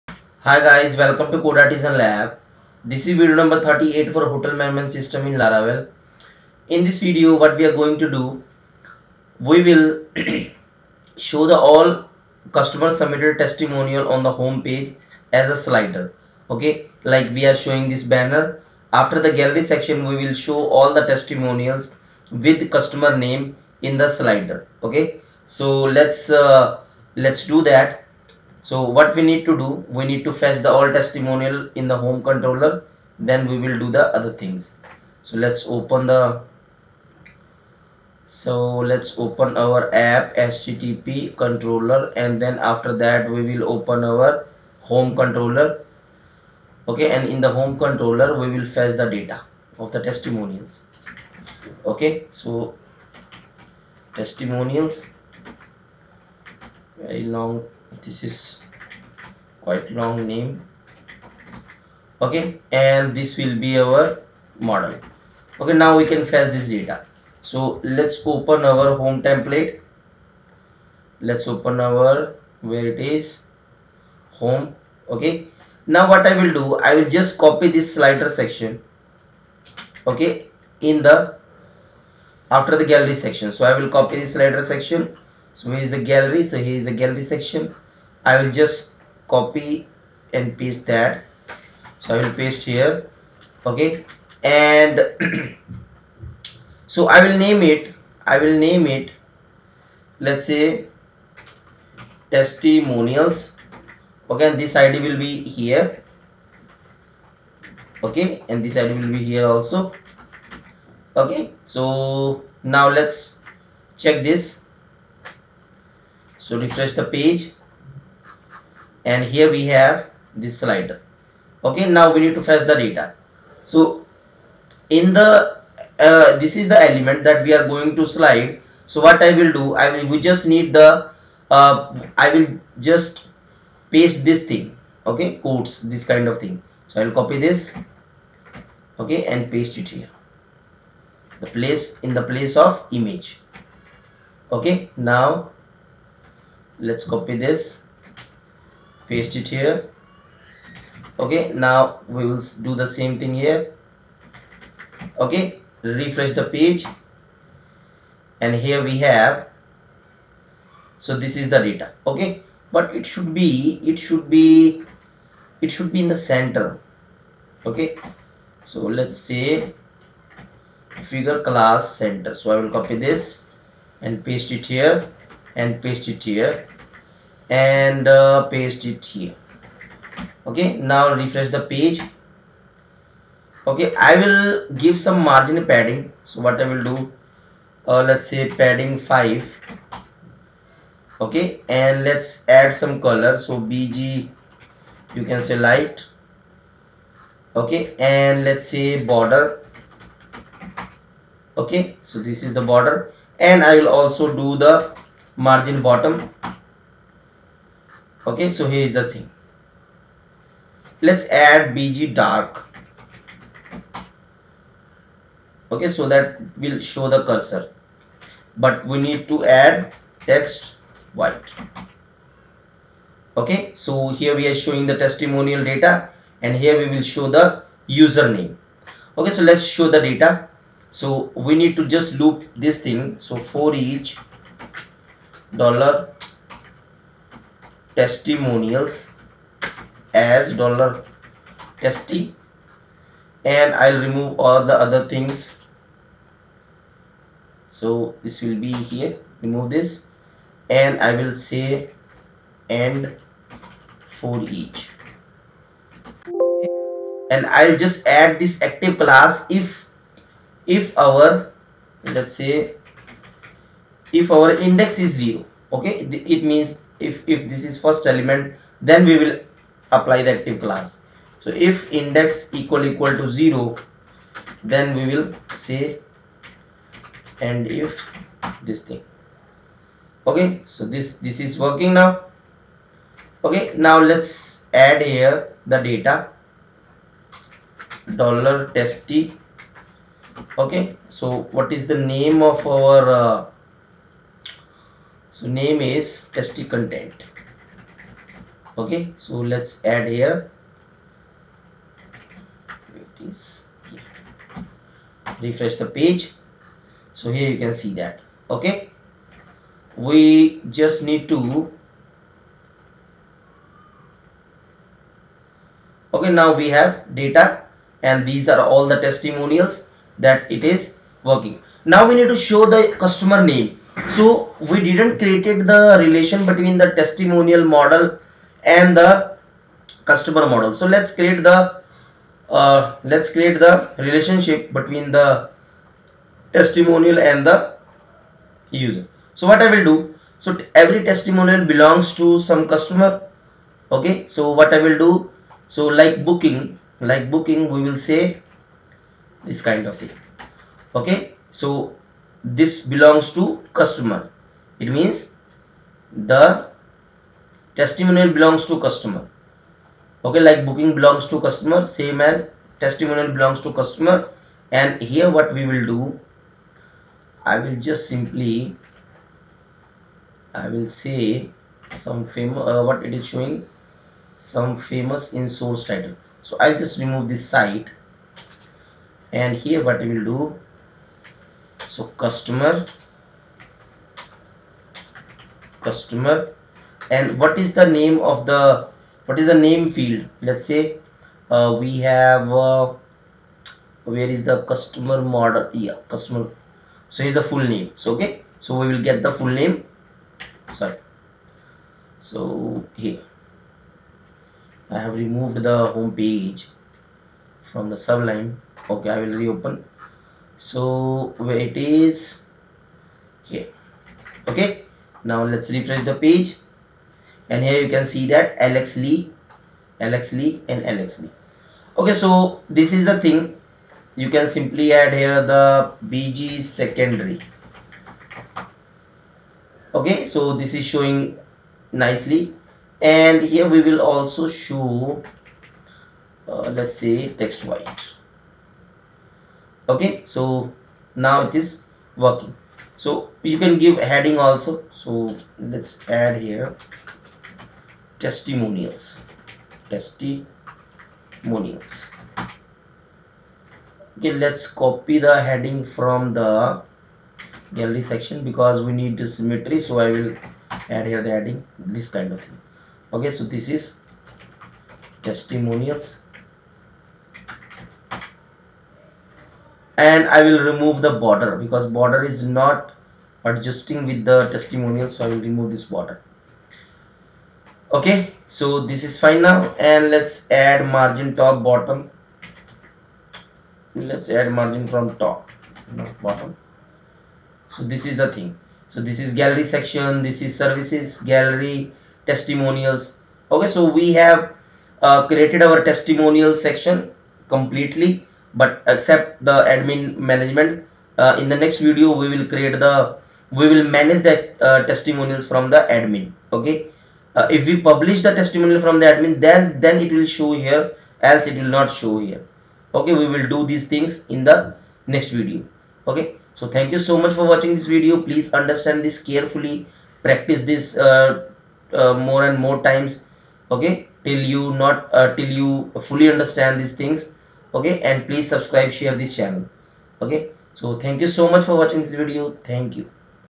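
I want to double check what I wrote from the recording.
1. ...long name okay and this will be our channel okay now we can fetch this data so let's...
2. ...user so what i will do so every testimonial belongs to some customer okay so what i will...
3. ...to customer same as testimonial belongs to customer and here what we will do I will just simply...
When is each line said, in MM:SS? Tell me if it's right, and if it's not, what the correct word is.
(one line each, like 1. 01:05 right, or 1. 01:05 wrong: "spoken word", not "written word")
1. 00:59 wrong: "model", not "channel"
2. 05:38 right
3. 06:01 right.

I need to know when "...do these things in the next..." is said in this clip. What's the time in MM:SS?
08:33.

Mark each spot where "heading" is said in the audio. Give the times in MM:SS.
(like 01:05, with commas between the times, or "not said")
07:23, 07:35, 07:41.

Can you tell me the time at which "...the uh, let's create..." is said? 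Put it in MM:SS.
05:31.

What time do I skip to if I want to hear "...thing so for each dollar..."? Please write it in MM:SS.
03:52.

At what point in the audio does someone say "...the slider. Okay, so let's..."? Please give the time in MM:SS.
00:23.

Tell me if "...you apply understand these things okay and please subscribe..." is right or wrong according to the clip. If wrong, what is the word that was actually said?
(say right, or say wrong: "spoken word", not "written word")
wrong: "fully", not "apply".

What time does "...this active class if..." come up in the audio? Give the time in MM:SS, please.
04:18.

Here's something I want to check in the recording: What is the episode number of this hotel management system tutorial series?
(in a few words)
38.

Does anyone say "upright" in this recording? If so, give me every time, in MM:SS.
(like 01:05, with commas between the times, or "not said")
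not said.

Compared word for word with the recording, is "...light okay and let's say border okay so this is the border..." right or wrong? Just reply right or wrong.
right.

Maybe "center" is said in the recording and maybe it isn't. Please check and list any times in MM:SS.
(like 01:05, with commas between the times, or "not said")
02:46, 02:51.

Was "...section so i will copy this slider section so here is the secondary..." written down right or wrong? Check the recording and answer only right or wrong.
wrong.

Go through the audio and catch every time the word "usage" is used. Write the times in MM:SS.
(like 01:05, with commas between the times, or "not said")
not said.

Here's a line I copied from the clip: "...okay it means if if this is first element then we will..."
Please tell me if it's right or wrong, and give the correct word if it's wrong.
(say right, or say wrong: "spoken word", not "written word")
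right.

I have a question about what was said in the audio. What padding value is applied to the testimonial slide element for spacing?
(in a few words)
5.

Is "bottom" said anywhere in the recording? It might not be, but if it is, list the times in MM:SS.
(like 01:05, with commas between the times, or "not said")
03:25, 08:01, 08:06.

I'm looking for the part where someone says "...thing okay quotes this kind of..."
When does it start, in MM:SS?
02:14.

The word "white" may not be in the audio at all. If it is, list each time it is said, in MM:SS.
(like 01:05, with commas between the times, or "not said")
03:41, 07:17.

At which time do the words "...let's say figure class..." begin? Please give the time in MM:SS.
02:48.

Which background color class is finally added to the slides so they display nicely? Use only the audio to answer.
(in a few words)
bg secondary.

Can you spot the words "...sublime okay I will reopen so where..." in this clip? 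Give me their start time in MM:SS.
06:47.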